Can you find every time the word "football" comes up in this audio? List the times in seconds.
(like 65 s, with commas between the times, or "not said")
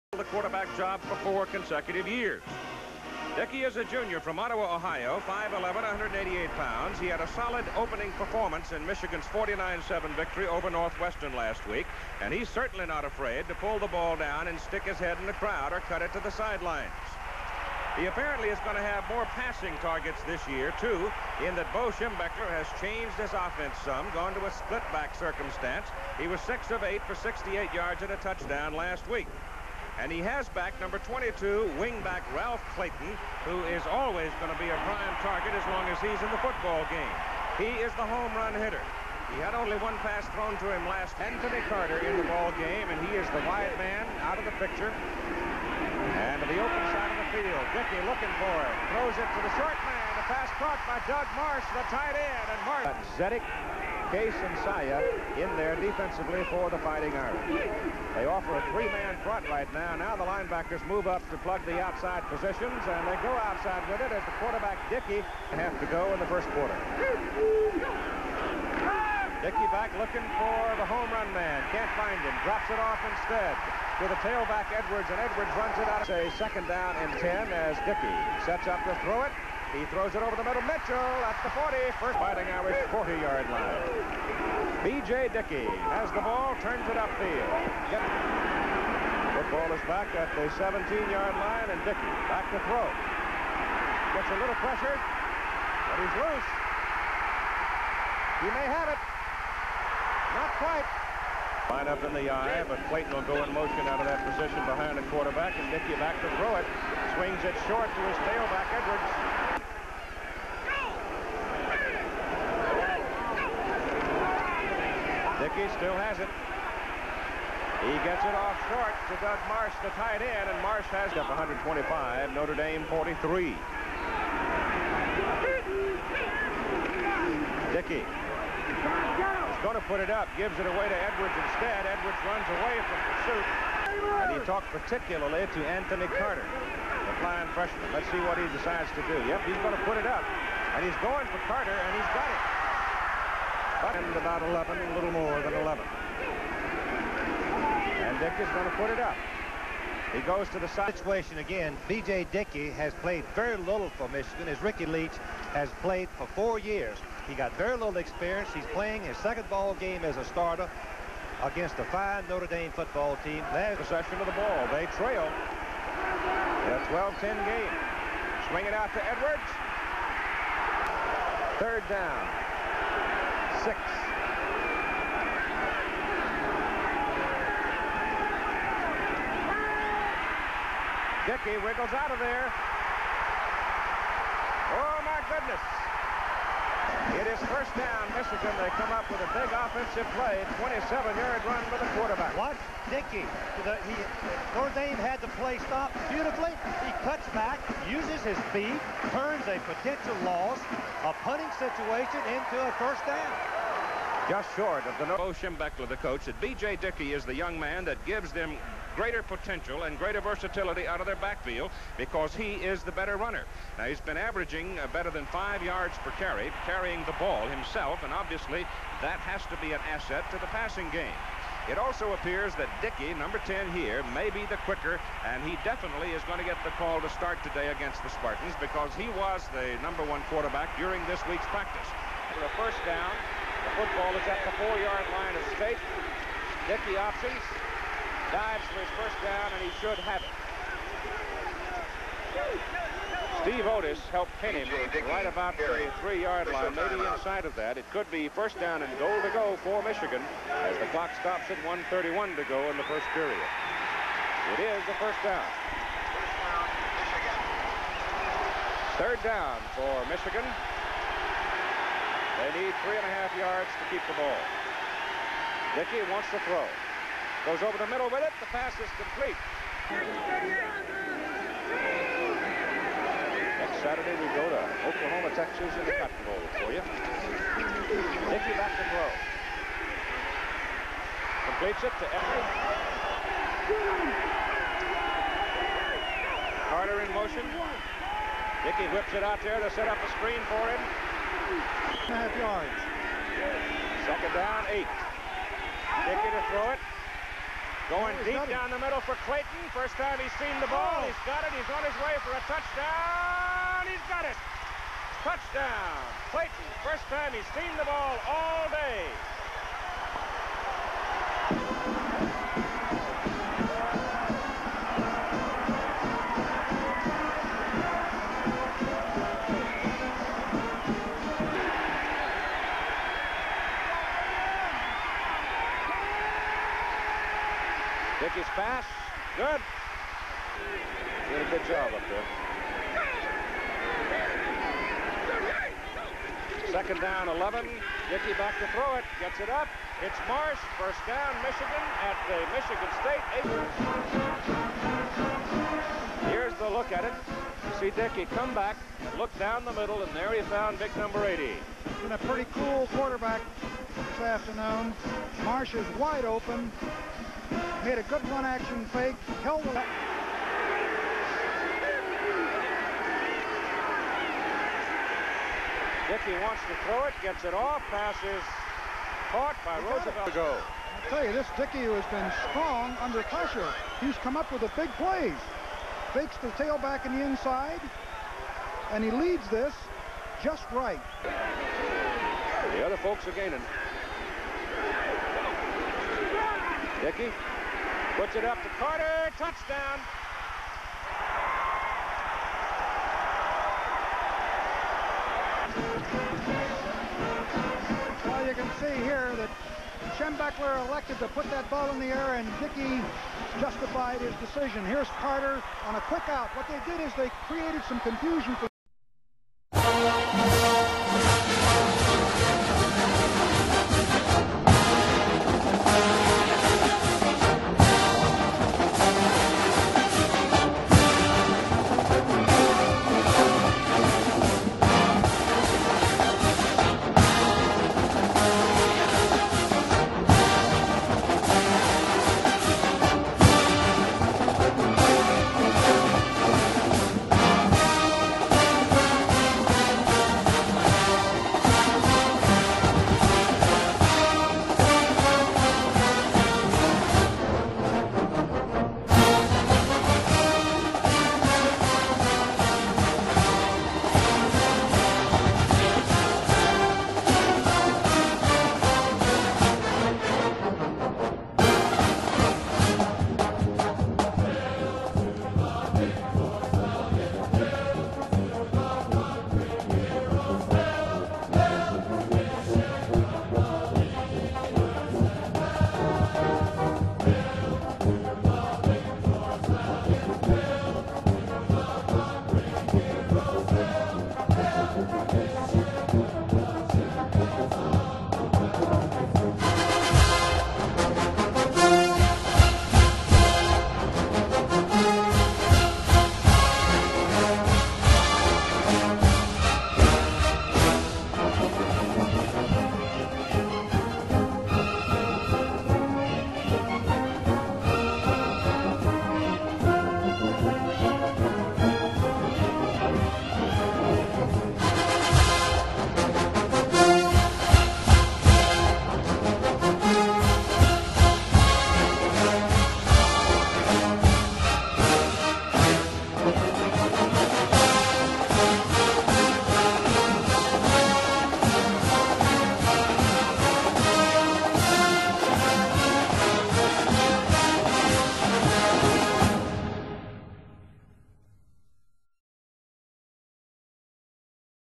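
36 s, 89 s, 162 s, 233 s.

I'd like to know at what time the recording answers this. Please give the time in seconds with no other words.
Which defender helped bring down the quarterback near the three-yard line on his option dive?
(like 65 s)
243 s.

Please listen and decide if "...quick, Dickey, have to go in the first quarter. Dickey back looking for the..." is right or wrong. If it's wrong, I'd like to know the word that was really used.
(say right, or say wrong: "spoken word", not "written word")
wrong: "quarterback", not "quick".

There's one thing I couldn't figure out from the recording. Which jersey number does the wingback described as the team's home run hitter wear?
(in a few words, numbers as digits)
22.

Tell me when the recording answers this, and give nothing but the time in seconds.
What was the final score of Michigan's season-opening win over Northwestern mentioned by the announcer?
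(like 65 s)
9 s.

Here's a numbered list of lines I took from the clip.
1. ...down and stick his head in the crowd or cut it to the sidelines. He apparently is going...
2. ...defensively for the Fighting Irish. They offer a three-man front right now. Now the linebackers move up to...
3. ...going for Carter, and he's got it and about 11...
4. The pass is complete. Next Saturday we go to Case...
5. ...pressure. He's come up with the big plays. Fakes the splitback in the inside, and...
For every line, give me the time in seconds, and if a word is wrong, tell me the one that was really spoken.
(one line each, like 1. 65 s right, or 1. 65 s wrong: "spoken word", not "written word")
1. 14 s right
2. 55 s right
3. 141 s right
4. 268 s wrong: "Oklahoma", not "Case"
5. 373 s wrong: "tailback", not "splitback".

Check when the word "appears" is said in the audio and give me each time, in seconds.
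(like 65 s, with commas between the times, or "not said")
222 s.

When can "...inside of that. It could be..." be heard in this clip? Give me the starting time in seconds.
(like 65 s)
247 s.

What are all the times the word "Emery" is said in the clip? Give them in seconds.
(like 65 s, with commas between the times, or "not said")
282 s.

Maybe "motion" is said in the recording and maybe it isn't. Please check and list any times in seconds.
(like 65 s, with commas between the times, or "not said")
103 s, 287 s.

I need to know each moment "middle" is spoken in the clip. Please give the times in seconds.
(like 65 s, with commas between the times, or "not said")
80 s, 267 s, 298 s, 349 s.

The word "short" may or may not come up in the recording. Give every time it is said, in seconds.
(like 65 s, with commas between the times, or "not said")
49 s, 107 s, 118 s, 204 s.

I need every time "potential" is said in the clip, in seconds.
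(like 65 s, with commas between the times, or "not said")
199 s, 209 s.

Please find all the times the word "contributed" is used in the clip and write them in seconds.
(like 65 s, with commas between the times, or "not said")
not said.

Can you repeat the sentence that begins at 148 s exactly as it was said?
And Dickey's going to put it up.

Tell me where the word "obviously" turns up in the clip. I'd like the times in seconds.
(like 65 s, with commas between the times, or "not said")
218 s.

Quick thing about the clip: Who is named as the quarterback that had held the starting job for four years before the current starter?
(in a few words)
Ricky Leach.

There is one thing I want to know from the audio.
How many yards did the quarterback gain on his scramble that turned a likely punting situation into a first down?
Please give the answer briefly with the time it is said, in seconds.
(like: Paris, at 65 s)
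27, at 190 s.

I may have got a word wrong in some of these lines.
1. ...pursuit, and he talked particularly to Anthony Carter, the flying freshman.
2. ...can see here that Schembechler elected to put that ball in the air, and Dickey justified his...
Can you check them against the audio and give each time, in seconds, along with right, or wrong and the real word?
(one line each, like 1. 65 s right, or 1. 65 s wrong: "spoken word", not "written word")
1. 133 s right
2. 398 s right.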